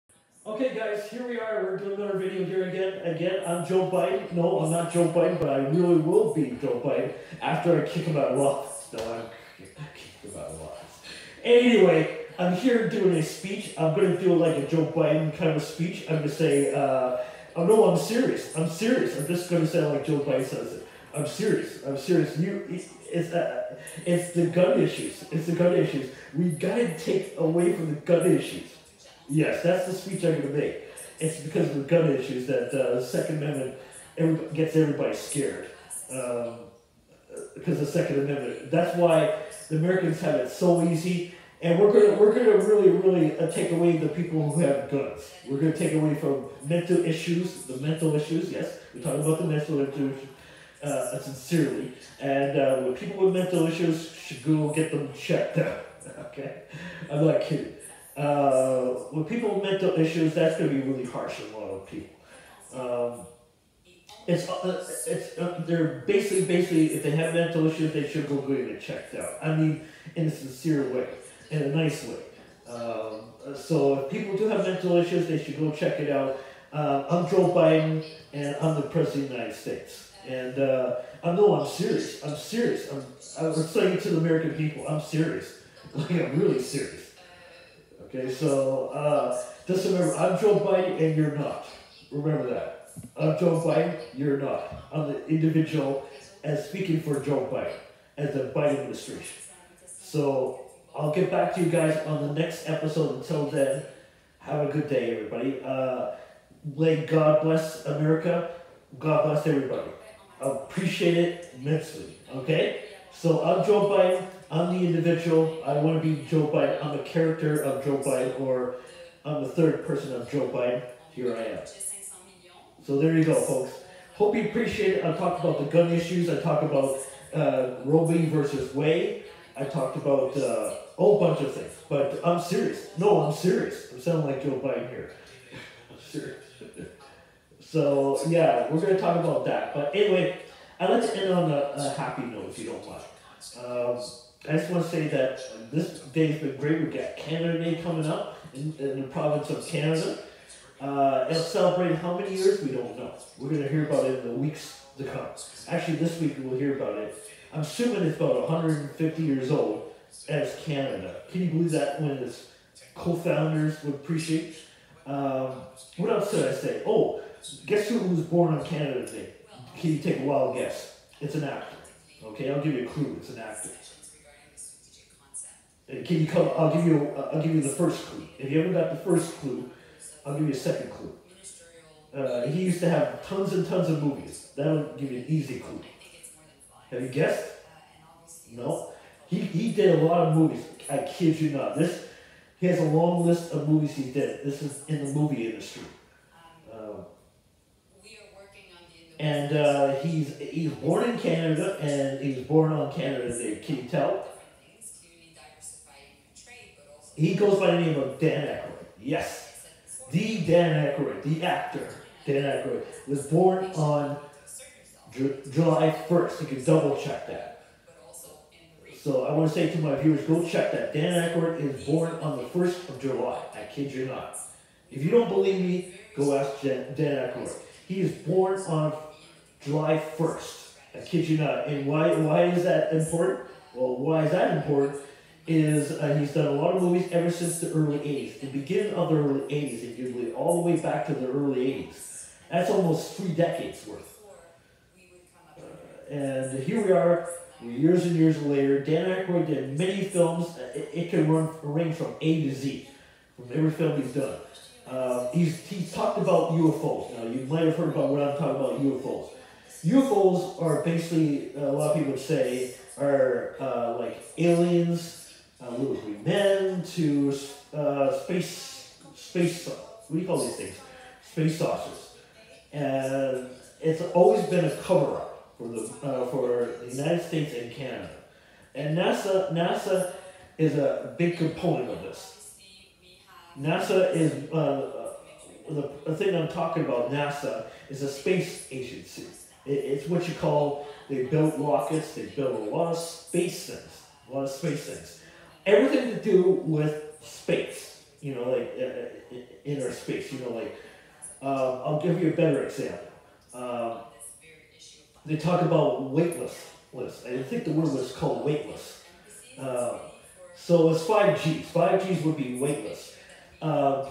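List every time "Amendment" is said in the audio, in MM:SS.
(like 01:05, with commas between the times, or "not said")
00:33, 00:38.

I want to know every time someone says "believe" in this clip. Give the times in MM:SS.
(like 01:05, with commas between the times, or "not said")
02:41, 03:45, 04:00.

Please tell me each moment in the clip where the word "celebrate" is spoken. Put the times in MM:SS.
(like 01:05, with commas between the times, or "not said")
02:31.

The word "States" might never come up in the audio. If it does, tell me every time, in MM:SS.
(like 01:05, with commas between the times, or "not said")
01:19, 04:37.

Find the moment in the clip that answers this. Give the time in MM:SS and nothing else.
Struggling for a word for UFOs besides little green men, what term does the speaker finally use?
04:31.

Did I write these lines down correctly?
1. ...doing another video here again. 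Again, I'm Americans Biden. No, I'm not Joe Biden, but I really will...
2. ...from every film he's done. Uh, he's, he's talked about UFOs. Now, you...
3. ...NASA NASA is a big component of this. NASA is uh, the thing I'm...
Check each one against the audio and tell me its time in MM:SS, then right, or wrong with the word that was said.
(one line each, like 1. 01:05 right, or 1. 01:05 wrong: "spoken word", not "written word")
1. 00:01 wrong: "Joe", not "Americans"
2. 04:13 right
3. 04:38 right.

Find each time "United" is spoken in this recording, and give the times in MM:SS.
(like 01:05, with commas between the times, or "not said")
01:19, 04:36.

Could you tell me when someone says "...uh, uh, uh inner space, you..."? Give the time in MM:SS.
04:58.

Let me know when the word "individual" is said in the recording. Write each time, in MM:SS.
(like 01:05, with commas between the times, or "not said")
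01:35, 01:54.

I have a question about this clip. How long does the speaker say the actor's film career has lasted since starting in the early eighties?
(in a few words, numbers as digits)
almost three decades.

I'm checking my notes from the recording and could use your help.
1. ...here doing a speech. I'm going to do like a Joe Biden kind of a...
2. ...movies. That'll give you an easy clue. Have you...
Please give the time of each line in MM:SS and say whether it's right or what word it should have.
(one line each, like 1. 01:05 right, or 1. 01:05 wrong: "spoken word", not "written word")
1. 00:12 right
2. 03:04 right.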